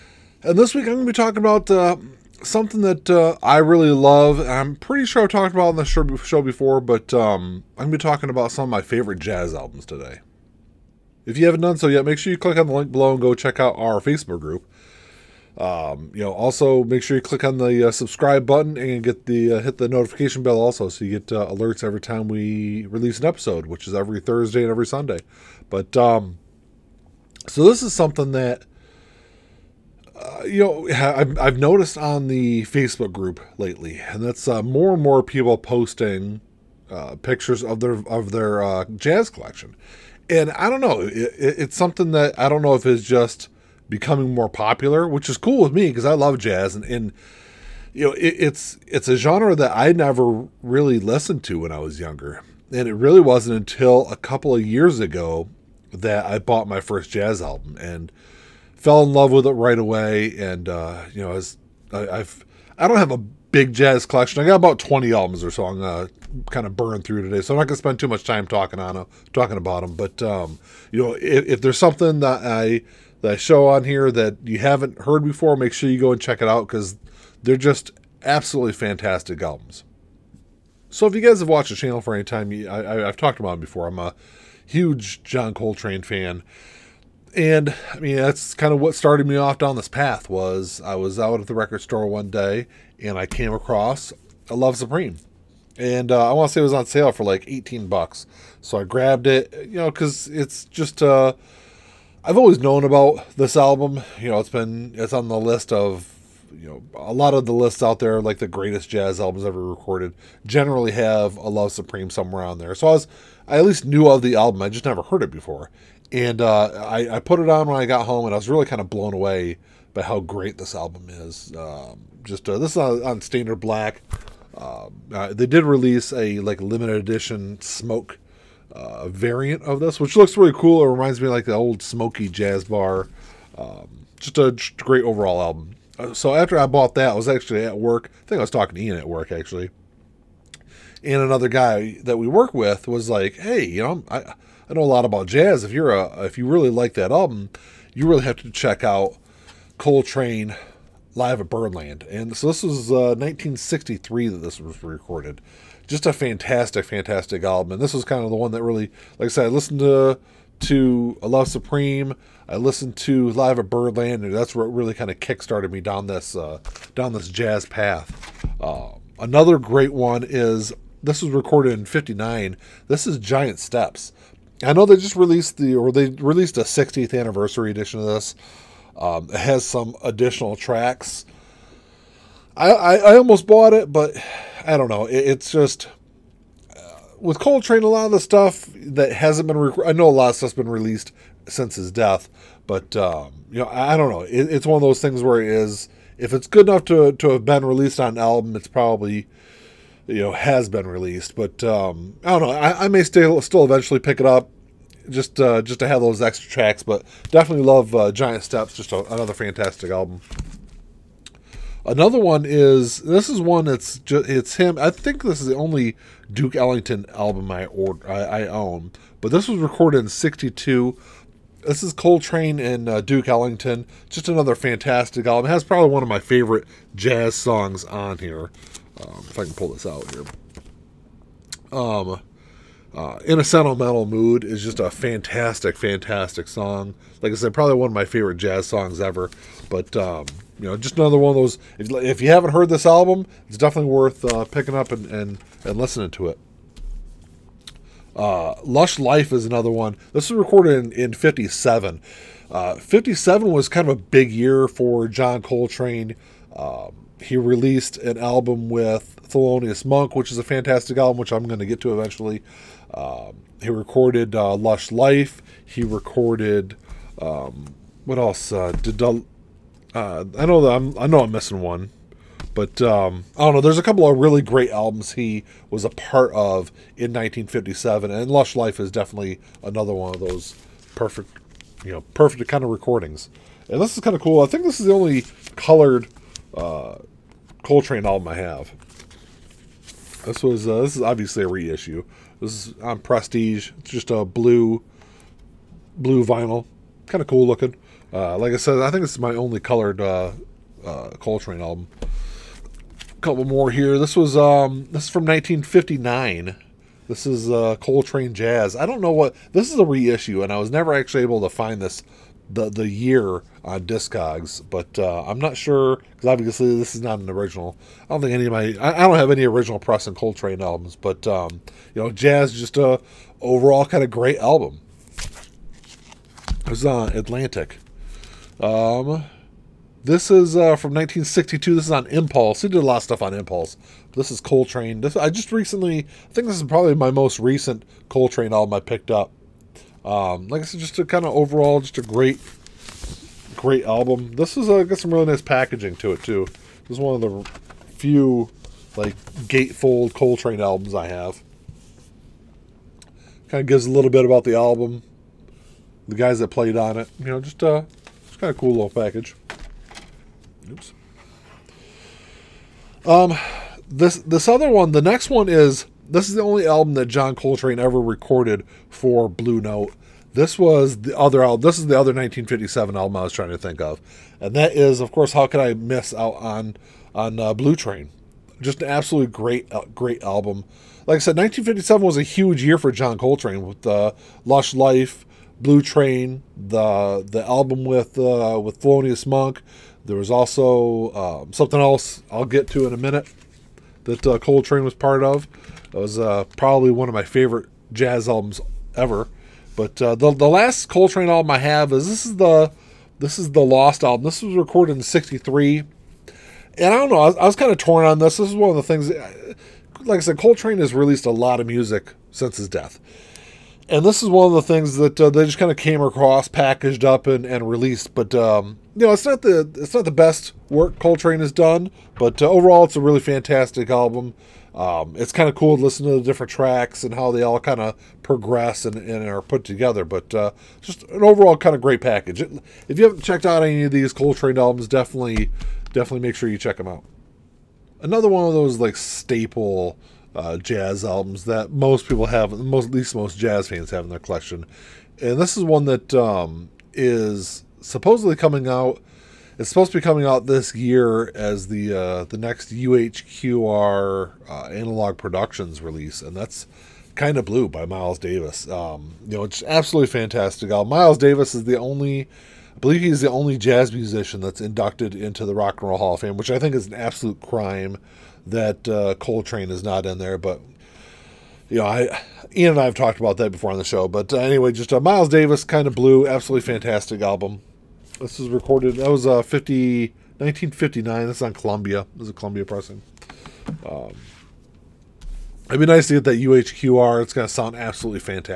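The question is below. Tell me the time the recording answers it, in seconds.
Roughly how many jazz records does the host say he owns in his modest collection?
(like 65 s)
64 s.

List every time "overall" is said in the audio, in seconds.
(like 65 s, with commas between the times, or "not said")
135 s, 323 s, 341 s, 422 s, 431 s.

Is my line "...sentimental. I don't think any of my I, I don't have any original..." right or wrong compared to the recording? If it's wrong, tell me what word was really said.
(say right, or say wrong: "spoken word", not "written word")
wrong: "original", not "sentimental".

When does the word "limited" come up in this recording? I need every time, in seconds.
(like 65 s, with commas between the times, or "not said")
126 s.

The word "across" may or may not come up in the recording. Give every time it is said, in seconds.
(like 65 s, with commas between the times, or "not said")
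93 s, 416 s.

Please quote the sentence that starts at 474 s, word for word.
But uh, anyway, just a uh, Miles Davis kind of blue, absolutely fantastic album.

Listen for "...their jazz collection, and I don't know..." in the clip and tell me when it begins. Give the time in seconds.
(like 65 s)
38 s.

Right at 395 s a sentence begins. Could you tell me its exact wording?
It was uh, probably one of my favorite jazz albums ever.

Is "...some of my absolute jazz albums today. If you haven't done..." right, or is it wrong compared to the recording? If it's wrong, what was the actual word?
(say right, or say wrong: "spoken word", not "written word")
wrong: "favorite", not "absolute".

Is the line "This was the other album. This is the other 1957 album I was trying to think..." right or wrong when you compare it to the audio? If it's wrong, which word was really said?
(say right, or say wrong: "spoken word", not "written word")
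right.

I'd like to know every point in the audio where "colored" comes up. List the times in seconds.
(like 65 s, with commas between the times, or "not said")
285 s, 299 s.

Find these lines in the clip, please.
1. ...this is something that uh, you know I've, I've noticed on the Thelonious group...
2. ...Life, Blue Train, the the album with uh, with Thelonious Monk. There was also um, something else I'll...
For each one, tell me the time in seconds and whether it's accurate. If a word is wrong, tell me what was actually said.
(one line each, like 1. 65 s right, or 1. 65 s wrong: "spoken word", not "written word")
1. 27 s wrong: "Facebook", not "Thelonious"
2. 384 s right.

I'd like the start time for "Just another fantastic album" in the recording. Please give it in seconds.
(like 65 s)
224 s.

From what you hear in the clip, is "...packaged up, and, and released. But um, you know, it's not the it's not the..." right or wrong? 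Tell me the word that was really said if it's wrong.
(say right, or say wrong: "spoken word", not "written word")
right.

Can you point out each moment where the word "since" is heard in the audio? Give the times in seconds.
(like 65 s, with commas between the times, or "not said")
191 s, 412 s.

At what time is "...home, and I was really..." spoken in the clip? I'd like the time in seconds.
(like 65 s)
118 s.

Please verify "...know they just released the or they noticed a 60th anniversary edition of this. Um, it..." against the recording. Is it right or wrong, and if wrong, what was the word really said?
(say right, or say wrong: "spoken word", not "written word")
wrong: "released", not "noticed".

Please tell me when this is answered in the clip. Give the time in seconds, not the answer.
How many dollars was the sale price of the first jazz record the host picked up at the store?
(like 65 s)
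97 s.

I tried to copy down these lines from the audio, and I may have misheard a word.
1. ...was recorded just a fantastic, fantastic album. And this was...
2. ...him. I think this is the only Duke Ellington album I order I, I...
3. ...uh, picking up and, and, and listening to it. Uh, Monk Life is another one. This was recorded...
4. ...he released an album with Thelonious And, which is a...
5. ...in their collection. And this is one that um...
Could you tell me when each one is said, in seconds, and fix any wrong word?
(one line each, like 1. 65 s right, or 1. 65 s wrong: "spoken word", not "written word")
1. 154 s right
2. 214 s right
3. 244 s wrong: "Lush", not "Monk"
4. 257 s wrong: "Monk", not "And"
5. 444 s right.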